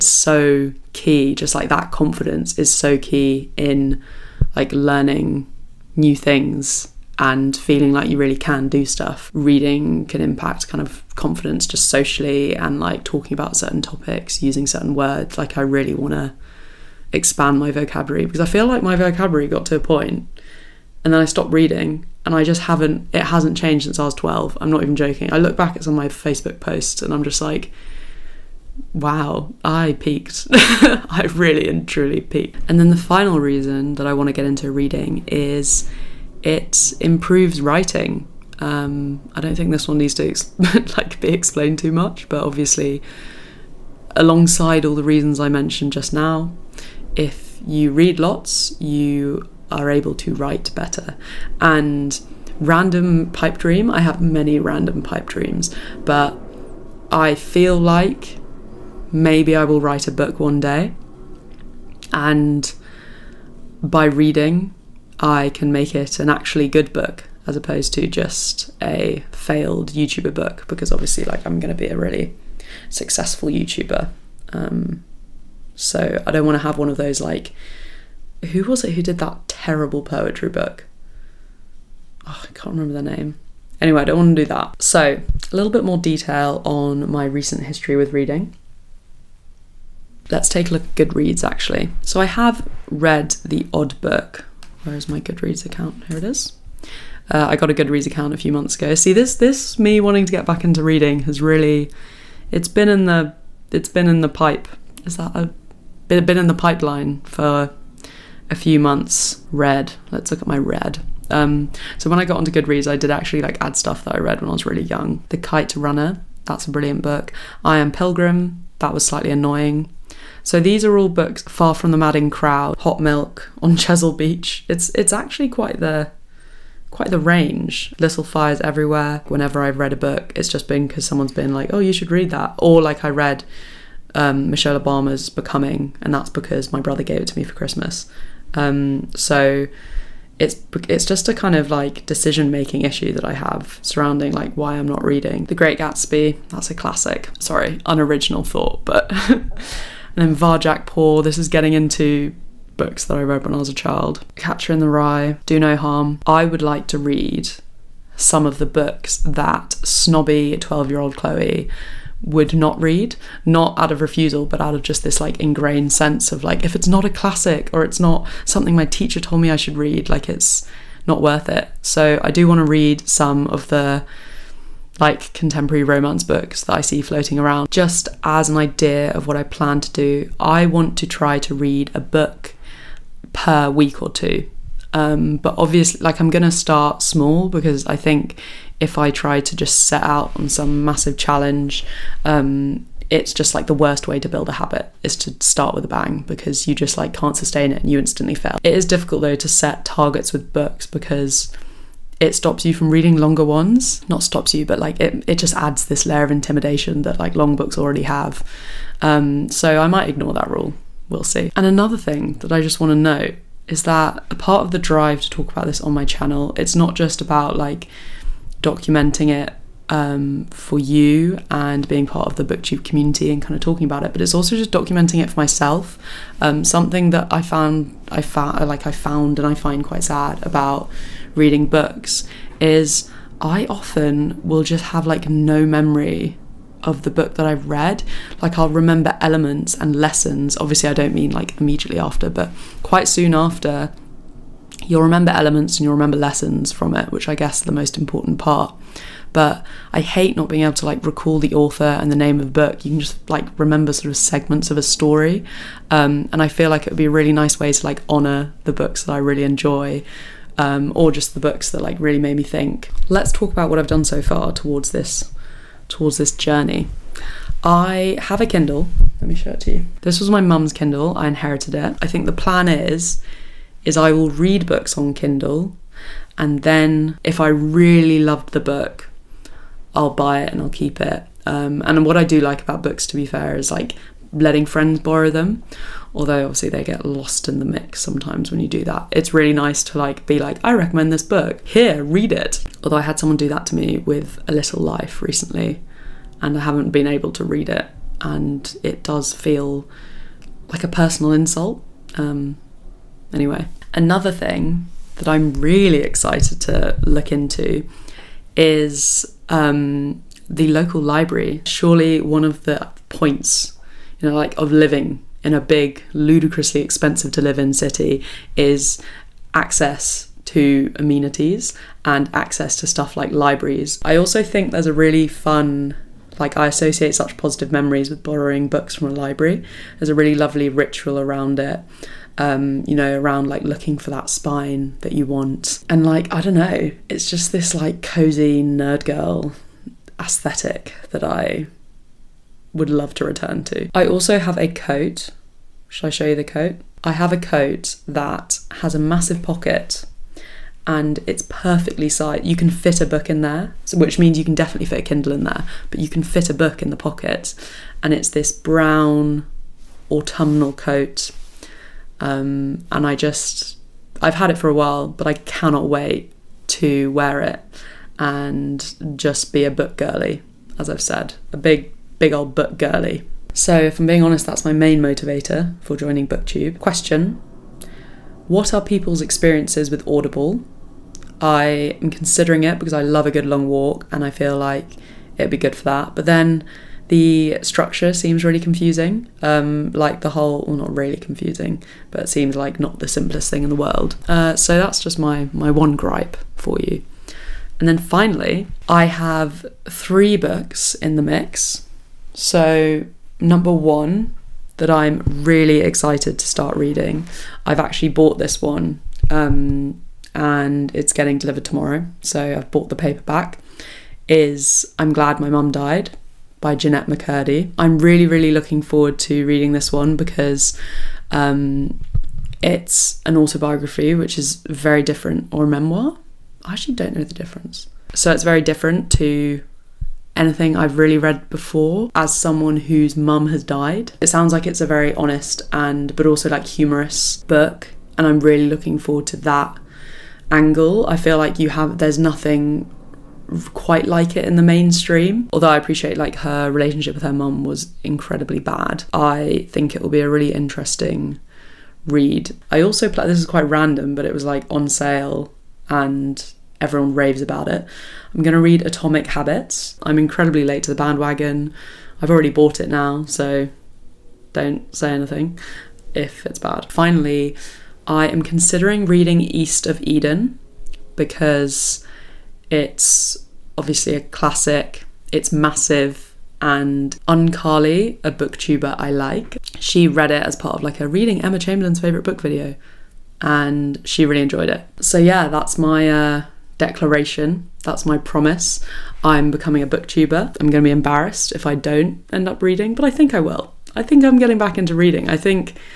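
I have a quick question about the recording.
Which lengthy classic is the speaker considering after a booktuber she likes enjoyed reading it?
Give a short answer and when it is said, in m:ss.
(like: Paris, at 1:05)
East of Eden, at 7:49.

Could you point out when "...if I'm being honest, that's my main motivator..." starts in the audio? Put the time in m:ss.
6:13.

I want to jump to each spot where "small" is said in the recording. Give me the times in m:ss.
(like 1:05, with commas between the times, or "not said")
3:07.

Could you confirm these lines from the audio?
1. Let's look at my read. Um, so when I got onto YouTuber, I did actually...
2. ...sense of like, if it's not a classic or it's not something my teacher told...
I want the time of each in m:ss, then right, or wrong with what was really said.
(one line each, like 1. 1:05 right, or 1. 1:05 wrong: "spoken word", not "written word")
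1. 1:50 wrong: "Goodreads", not "YouTuber"
2. 2:45 right.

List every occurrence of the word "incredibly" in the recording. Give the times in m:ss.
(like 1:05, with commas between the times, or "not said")
7:28, 7:40.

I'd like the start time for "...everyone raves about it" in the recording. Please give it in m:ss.
7:36.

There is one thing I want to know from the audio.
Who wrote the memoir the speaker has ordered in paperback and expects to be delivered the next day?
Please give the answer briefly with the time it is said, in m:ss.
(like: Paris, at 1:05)
Jennette McCurdy, at 6:56.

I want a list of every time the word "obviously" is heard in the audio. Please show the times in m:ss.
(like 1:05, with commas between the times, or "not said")
0:42, 1:10, 3:05, 4:00, 4:46, 7:53.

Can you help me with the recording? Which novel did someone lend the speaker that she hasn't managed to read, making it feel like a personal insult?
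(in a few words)
A Little Life.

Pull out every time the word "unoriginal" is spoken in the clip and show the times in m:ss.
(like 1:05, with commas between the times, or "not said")
2:27.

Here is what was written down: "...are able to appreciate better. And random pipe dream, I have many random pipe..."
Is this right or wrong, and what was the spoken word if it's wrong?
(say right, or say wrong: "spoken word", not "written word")
wrong: "write", not "appreciate".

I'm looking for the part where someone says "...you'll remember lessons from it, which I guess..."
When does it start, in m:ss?
4:05.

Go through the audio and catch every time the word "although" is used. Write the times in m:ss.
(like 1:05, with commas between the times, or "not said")
4:46, 4:52, 7:25.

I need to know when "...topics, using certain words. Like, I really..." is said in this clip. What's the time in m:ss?
0:13.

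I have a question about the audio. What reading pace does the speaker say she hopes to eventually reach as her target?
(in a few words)
a book per week or two.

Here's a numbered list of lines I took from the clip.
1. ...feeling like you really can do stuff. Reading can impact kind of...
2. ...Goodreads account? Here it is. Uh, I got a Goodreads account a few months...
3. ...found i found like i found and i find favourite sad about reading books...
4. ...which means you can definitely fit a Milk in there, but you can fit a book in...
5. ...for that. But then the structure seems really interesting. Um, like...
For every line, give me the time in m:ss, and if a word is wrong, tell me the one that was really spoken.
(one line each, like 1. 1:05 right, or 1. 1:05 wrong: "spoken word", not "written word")
1. 0:07 right
2. 1:35 right
3. 3:47 wrong: "quite", not "favourite"
4. 5:53 wrong: "Kindle", not "Milk"
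5. 6:25 wrong: "confusing", not "interesting".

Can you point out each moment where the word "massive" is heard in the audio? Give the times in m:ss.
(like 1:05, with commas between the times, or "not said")
3:10, 5:48, 7:55.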